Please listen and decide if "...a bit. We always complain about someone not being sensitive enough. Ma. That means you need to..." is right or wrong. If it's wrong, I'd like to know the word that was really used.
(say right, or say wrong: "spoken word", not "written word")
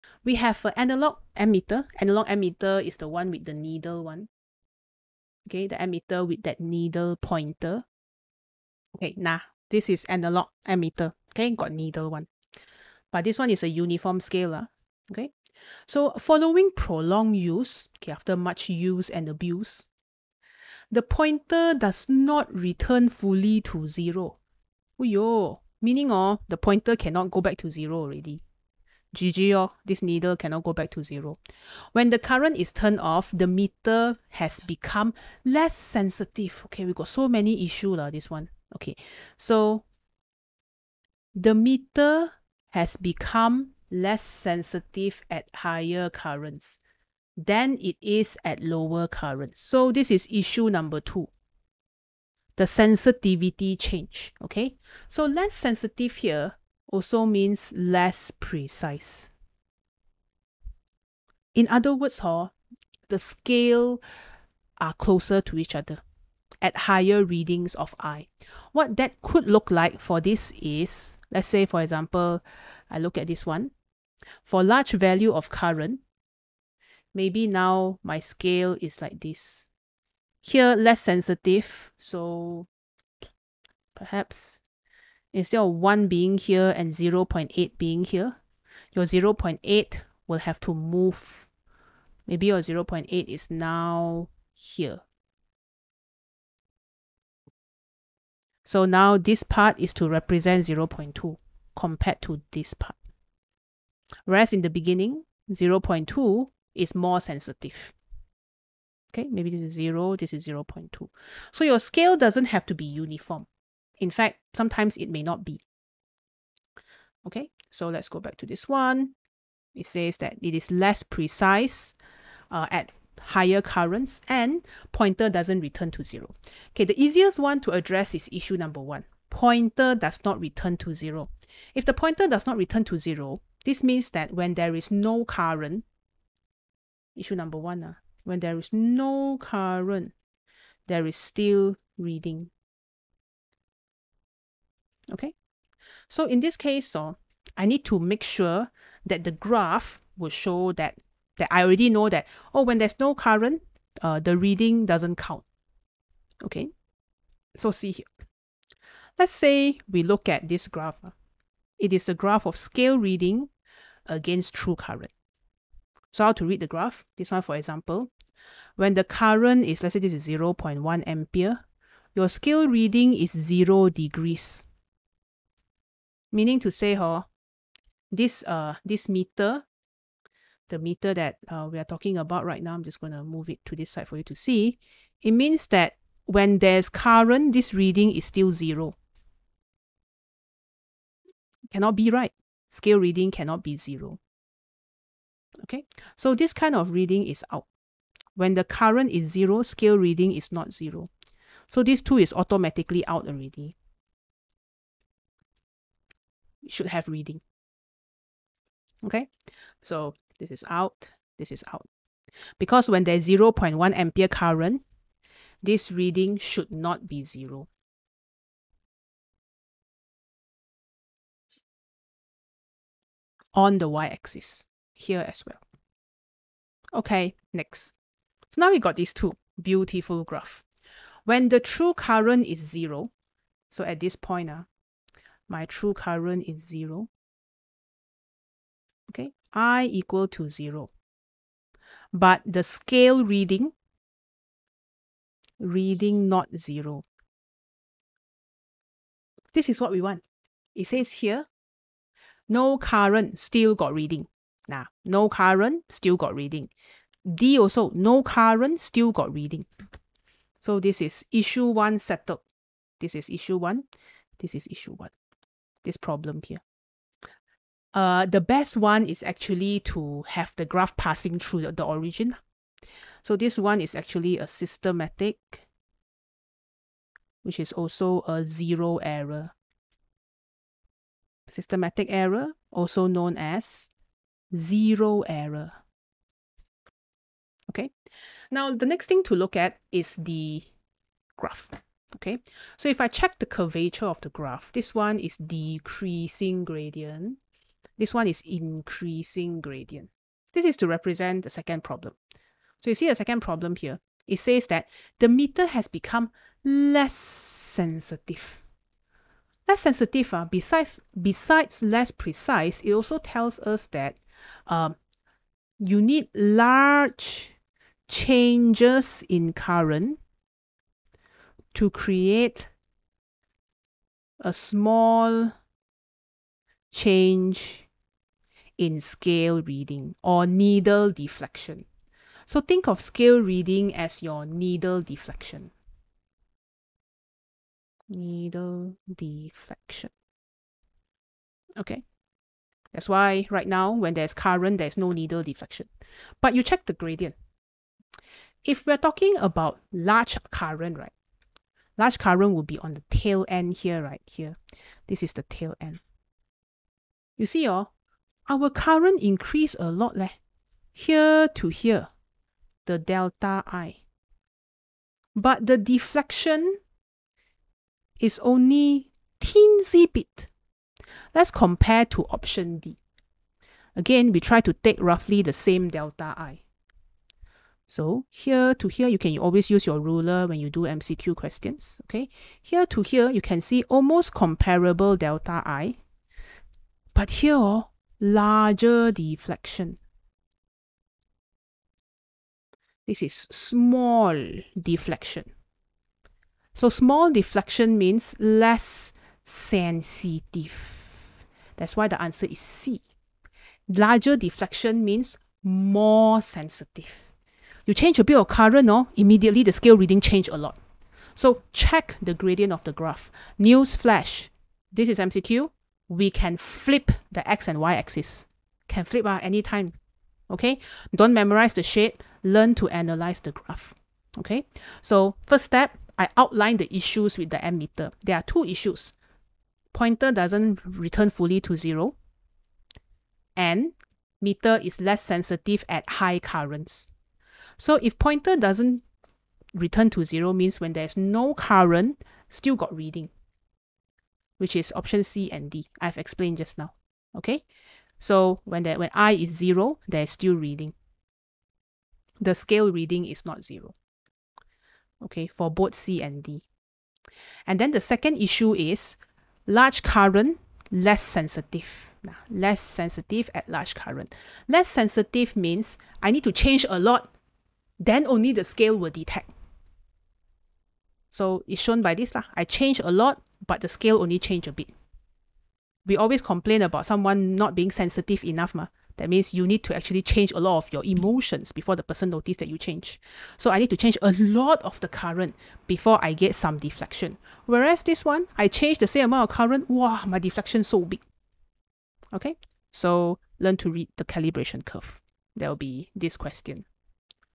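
right.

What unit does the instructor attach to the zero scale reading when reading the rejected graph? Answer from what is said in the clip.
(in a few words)
degrees.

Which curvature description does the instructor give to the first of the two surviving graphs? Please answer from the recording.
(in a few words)
decreasing gradient.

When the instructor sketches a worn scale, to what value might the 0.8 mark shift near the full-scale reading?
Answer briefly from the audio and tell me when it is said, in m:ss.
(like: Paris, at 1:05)
0.2, at 1:38.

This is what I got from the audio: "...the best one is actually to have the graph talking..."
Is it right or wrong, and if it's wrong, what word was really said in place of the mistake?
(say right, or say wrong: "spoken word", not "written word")
wrong: "passing", not "talking".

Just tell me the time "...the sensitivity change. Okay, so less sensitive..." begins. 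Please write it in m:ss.
0:52.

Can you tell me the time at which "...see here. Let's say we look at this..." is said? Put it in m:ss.
2:37.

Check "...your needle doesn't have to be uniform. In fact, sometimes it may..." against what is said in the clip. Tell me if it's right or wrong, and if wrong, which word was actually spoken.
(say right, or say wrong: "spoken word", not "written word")
wrong: "scale", not "needle".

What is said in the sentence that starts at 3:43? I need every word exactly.
On the y-axis here as well.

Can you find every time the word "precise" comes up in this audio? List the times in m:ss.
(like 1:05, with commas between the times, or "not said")
0:58, 2:01, 5:12.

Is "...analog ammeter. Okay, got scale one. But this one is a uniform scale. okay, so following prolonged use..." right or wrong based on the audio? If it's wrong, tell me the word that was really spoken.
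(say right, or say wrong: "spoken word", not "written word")
wrong: "needle", not "scale".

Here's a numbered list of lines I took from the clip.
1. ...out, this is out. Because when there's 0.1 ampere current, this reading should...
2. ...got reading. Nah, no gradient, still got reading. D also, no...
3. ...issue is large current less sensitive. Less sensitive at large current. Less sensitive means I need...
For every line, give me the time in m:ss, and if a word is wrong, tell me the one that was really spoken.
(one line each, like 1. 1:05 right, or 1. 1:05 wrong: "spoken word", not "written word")
1. 3:30 right
2. 4:13 wrong: "current", not "gradient"
3. 7:38 right.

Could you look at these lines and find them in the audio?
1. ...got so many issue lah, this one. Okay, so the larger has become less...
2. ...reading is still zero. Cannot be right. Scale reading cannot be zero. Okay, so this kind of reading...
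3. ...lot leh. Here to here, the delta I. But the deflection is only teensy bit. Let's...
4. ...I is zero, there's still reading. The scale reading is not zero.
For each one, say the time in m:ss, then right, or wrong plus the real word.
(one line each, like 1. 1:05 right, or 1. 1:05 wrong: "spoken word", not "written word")
1. 0:36 wrong: "meter", not "larger"
2. 3:07 right
3. 5:59 right
4. 7:29 right.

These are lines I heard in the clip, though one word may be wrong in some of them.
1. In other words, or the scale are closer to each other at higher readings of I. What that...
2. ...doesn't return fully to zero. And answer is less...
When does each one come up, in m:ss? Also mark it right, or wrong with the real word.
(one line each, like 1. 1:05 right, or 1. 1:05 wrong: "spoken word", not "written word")
1. 1:01 right
2. 7:10 wrong: "meter", not "answer".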